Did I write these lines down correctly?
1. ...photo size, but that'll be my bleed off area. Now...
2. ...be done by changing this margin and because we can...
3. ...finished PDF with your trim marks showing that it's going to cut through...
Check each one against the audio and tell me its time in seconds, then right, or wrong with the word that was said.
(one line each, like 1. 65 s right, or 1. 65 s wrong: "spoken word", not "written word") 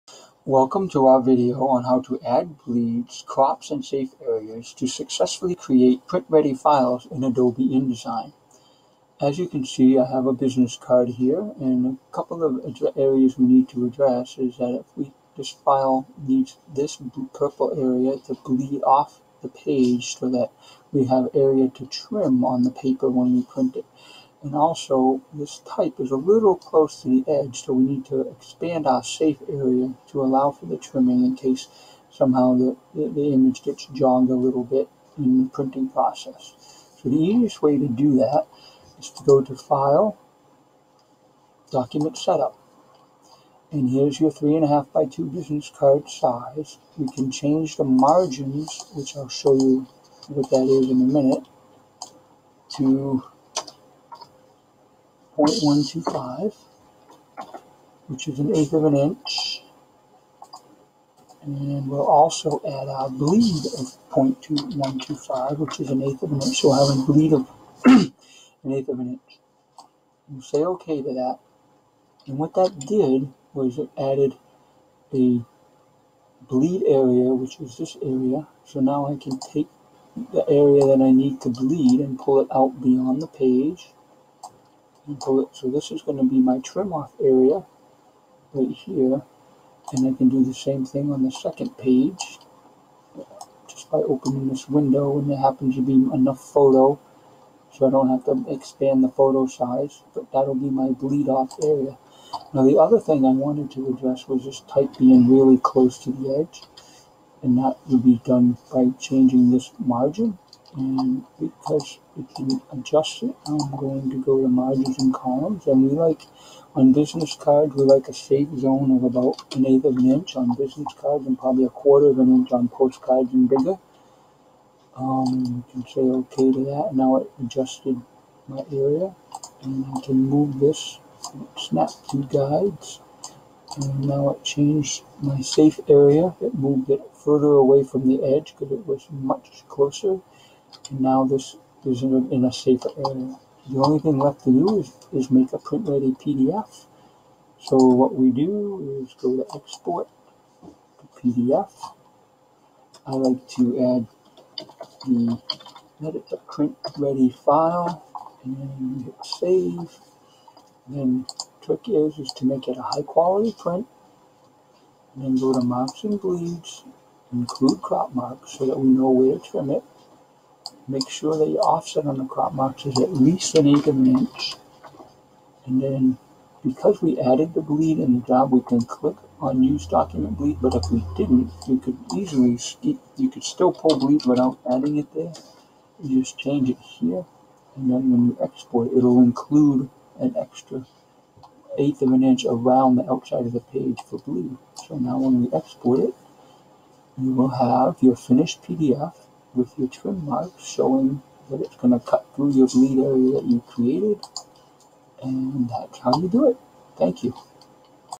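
1. 99 s right
2. 108 s right
3. 198 s right.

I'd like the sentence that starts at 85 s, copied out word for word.
So this is going to be my trim off area right here.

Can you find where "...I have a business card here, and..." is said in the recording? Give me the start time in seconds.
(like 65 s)
9 s.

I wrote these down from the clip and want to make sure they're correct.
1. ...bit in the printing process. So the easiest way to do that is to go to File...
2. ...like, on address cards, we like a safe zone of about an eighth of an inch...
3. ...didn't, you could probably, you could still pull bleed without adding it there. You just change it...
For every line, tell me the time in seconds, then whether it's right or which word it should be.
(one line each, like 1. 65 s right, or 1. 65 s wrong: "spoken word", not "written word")
1. 34 s right
2. 115 s wrong: "business", not "address"
3. 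181 s wrong: "easily", not "probably".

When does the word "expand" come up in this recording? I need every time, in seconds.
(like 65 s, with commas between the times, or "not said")
28 s, 98 s.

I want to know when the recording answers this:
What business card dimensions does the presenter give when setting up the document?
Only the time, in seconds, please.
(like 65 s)
44 s.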